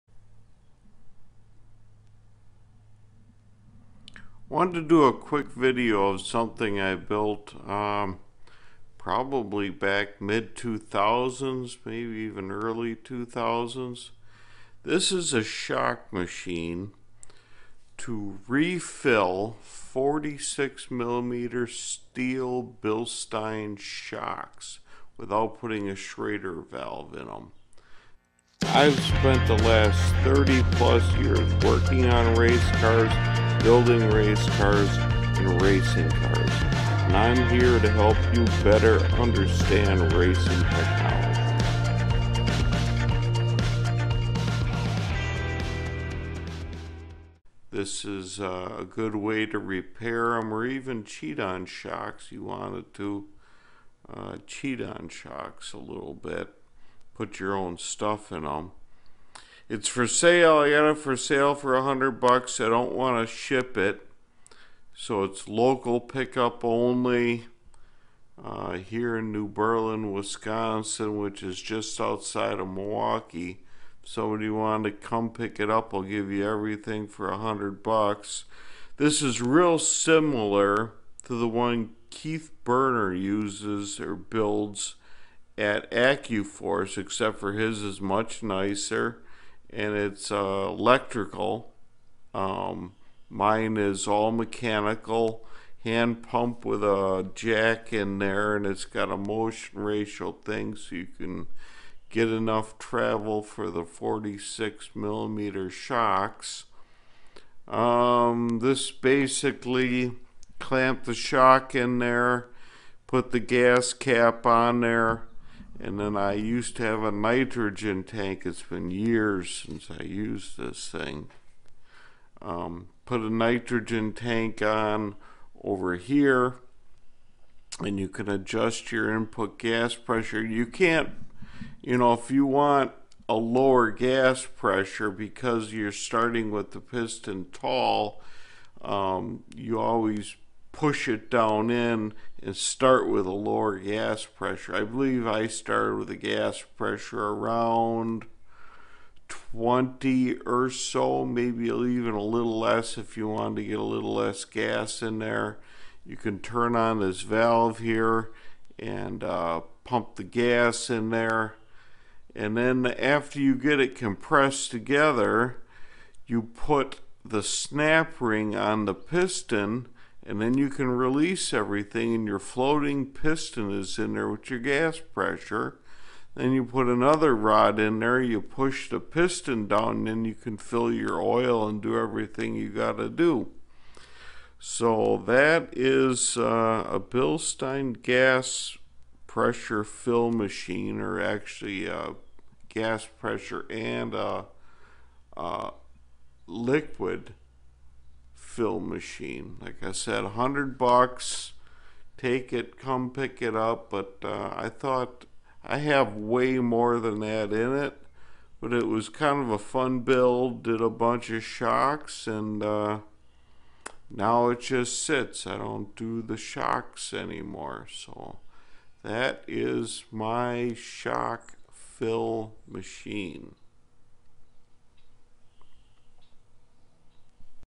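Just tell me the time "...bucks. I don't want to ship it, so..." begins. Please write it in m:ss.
1:02.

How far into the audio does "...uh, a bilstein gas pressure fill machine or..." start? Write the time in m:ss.
3:06.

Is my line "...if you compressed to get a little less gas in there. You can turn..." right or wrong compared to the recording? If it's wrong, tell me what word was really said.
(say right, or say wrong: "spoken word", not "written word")
wrong: "wanted", not "compressed".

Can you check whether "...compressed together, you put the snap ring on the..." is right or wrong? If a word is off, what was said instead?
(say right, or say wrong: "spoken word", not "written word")
right.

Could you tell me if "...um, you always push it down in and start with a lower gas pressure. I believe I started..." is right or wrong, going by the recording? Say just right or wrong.
right.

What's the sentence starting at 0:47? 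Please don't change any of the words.
This is uh, a good way to repair them or even cheat on shocks.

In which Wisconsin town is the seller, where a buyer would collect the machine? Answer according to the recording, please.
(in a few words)
New Berlin.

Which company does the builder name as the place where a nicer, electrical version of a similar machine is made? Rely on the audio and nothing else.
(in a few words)
AccuForce.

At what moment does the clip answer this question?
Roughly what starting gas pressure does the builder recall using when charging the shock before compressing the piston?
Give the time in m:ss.
2:29.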